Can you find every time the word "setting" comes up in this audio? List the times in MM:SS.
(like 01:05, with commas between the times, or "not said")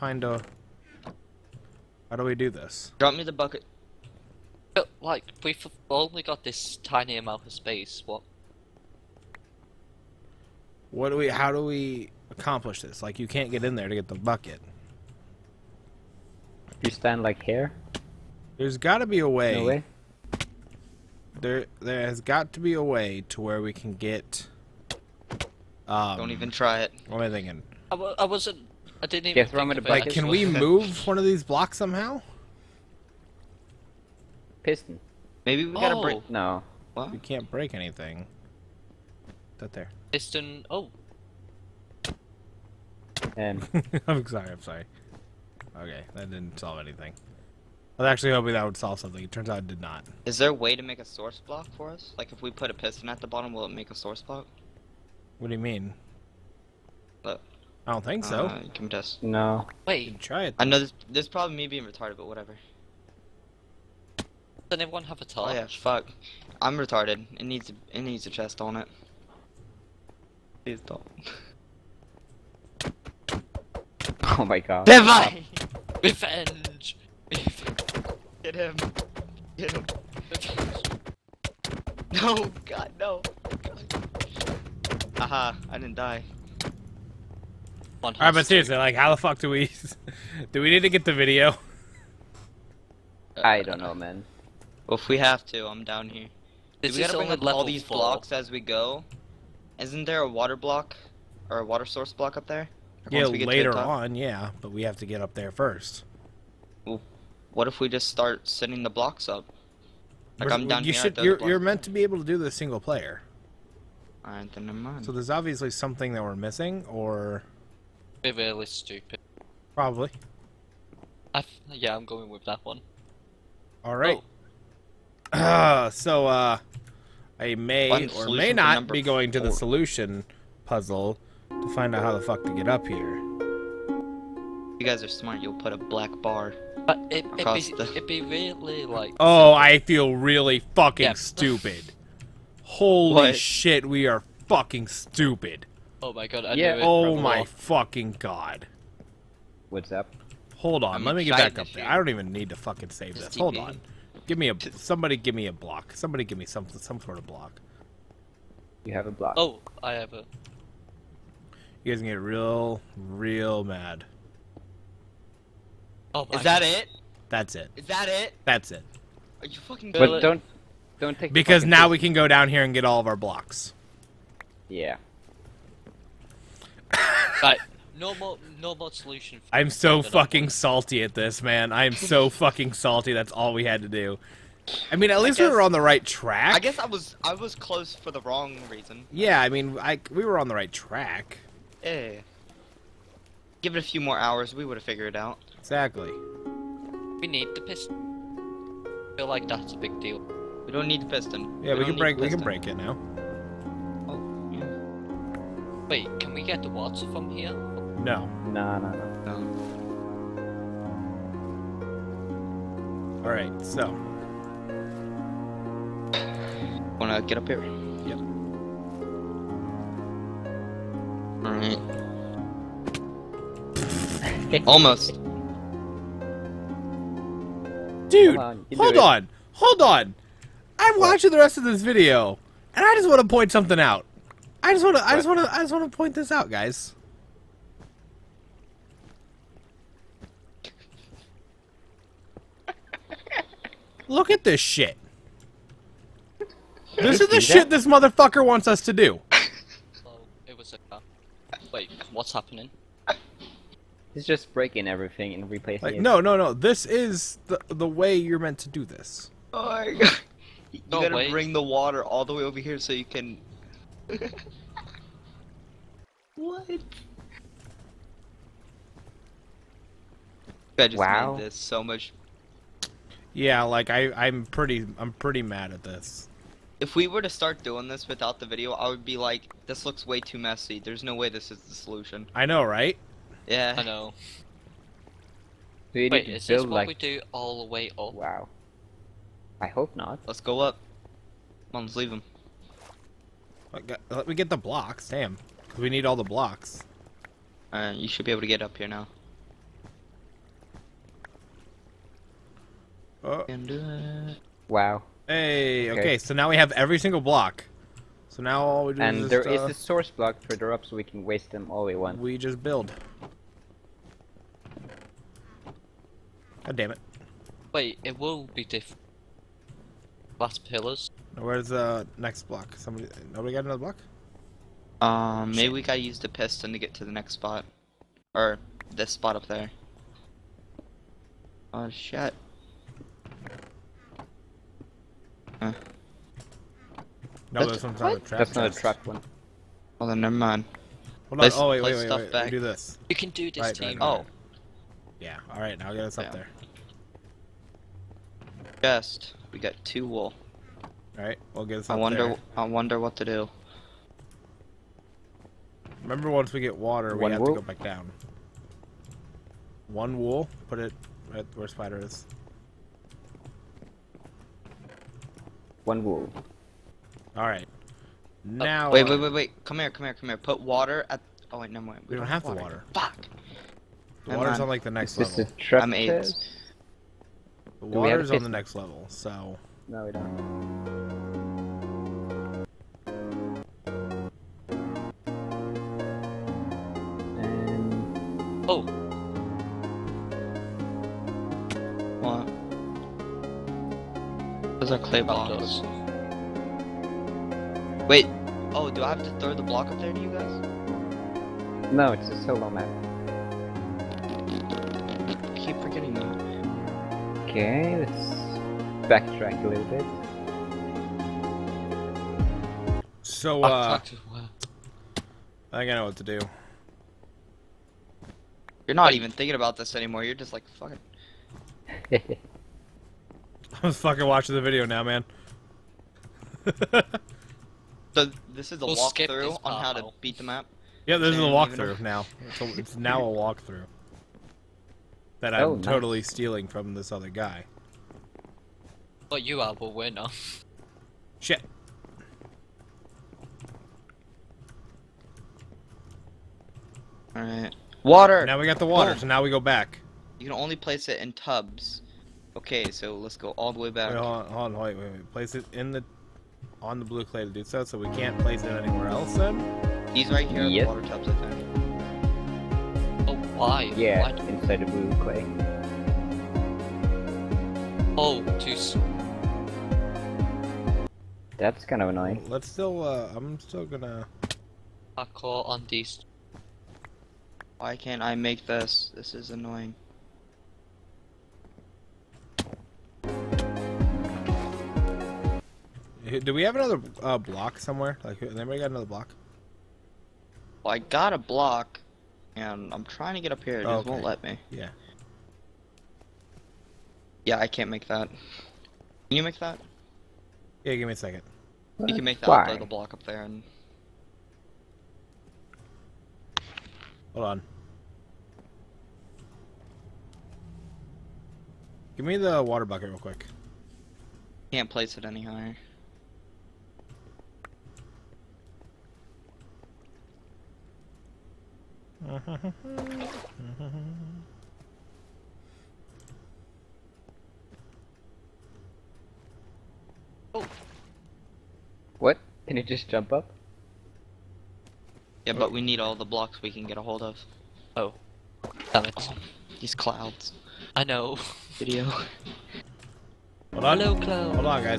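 01:48.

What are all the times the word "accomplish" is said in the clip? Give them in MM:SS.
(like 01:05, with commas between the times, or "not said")
00:12.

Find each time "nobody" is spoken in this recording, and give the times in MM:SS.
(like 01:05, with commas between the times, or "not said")
05:23.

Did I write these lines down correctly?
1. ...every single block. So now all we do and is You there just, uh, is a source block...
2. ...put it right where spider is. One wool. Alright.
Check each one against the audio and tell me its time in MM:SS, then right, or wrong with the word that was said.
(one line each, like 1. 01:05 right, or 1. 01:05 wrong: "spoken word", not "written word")
1. 05:06 wrong: "And", not "You"
2. 06:00 right.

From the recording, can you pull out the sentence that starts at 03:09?
Yeah, I mean, I we were on the right track.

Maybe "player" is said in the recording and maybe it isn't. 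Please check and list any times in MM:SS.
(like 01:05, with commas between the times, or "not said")
01:52.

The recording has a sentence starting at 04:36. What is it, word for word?
If we were to start doing this without the video, I would be like, this looks way too messy.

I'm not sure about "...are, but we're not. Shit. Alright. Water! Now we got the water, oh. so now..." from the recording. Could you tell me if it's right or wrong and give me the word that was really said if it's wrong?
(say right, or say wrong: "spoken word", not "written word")
right.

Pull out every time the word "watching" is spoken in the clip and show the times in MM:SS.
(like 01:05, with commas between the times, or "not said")
03:51, 07:04.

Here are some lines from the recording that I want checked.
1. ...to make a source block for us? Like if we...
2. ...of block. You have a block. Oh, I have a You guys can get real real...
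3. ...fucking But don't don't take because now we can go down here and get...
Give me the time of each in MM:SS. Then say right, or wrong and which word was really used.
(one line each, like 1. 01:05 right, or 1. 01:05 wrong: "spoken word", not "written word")
1. 00:50 right
2. 02:37 right
3. 02:49 right.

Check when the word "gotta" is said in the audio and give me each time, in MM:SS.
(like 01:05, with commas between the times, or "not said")
00:35, 01:36, 04:21, 05:25.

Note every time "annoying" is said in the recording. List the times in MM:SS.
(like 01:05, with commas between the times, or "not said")
07:52, 07:59.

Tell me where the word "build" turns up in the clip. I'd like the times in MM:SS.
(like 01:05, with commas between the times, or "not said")
04:46, 05:12.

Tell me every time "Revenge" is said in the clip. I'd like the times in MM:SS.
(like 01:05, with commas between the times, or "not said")
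01:16, 01:20.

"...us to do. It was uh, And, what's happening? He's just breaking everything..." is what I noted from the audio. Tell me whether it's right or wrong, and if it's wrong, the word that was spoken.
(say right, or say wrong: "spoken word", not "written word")
wrong: "Wait", not "And".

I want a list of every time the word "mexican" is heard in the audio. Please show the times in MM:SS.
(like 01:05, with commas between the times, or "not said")
not said.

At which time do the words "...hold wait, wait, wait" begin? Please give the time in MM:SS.
07:34.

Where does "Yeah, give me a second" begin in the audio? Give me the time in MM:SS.
08:20.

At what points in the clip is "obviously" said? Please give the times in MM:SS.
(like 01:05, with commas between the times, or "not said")
01:55.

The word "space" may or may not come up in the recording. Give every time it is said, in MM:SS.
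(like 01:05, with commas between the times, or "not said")
00:07.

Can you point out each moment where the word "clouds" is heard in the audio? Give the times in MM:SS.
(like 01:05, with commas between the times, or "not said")
08:59.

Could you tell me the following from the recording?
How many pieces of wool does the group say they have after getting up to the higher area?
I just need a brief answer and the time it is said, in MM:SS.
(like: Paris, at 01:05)
Two, at 05:49.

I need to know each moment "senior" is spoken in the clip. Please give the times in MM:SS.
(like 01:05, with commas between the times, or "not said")
not said.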